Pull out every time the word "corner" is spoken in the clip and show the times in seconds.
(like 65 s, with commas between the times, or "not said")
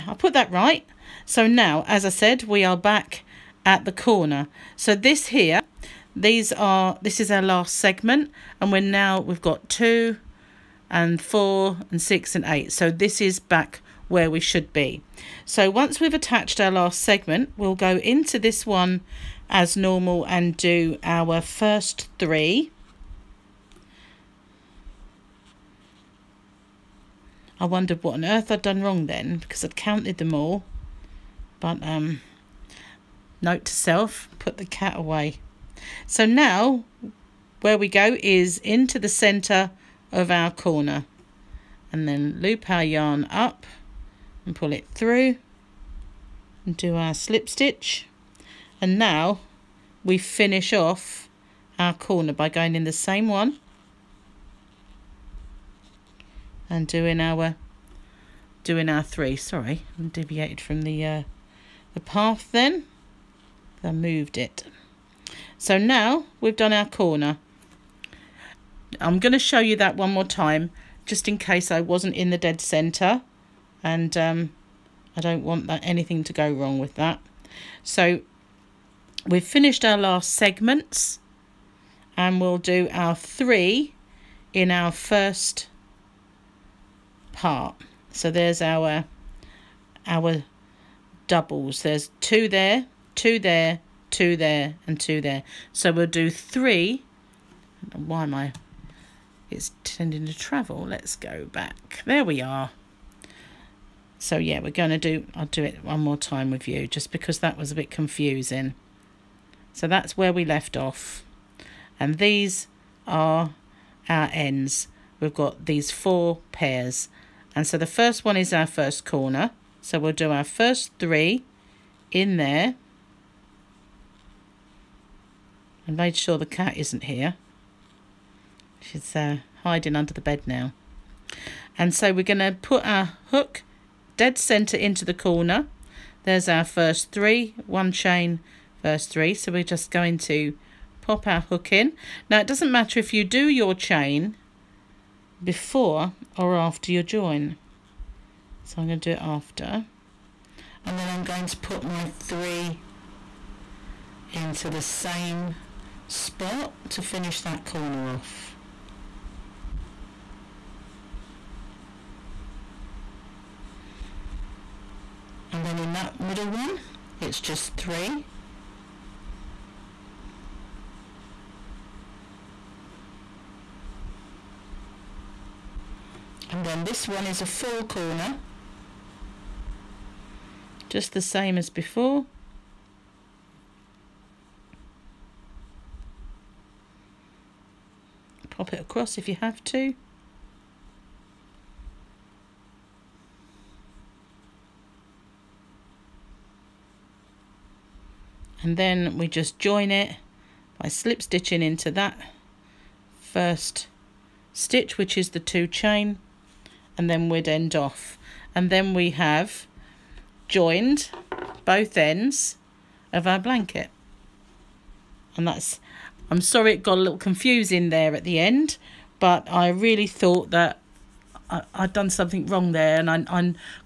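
3 s, 40 s, 51 s, 66 s, 119 s, 135 s, 157 s, 177 s.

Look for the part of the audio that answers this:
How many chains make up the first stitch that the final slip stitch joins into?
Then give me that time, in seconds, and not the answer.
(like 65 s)
205 s.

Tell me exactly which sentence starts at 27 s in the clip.
I wondered what on earth I'd done wrong then because I'd counted them all.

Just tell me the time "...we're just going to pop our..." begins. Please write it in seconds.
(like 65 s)
139 s.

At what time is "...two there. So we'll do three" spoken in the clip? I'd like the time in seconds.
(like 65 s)
94 s.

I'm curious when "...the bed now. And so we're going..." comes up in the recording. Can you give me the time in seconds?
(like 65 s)
130 s.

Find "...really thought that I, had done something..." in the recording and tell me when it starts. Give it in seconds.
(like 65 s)
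219 s.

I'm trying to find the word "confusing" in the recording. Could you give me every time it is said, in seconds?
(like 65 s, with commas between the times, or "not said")
107 s, 217 s.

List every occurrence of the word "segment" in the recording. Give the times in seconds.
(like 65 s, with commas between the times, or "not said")
7 s, 16 s, 80 s.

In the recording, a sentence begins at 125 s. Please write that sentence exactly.
And made sure the cat isn't here.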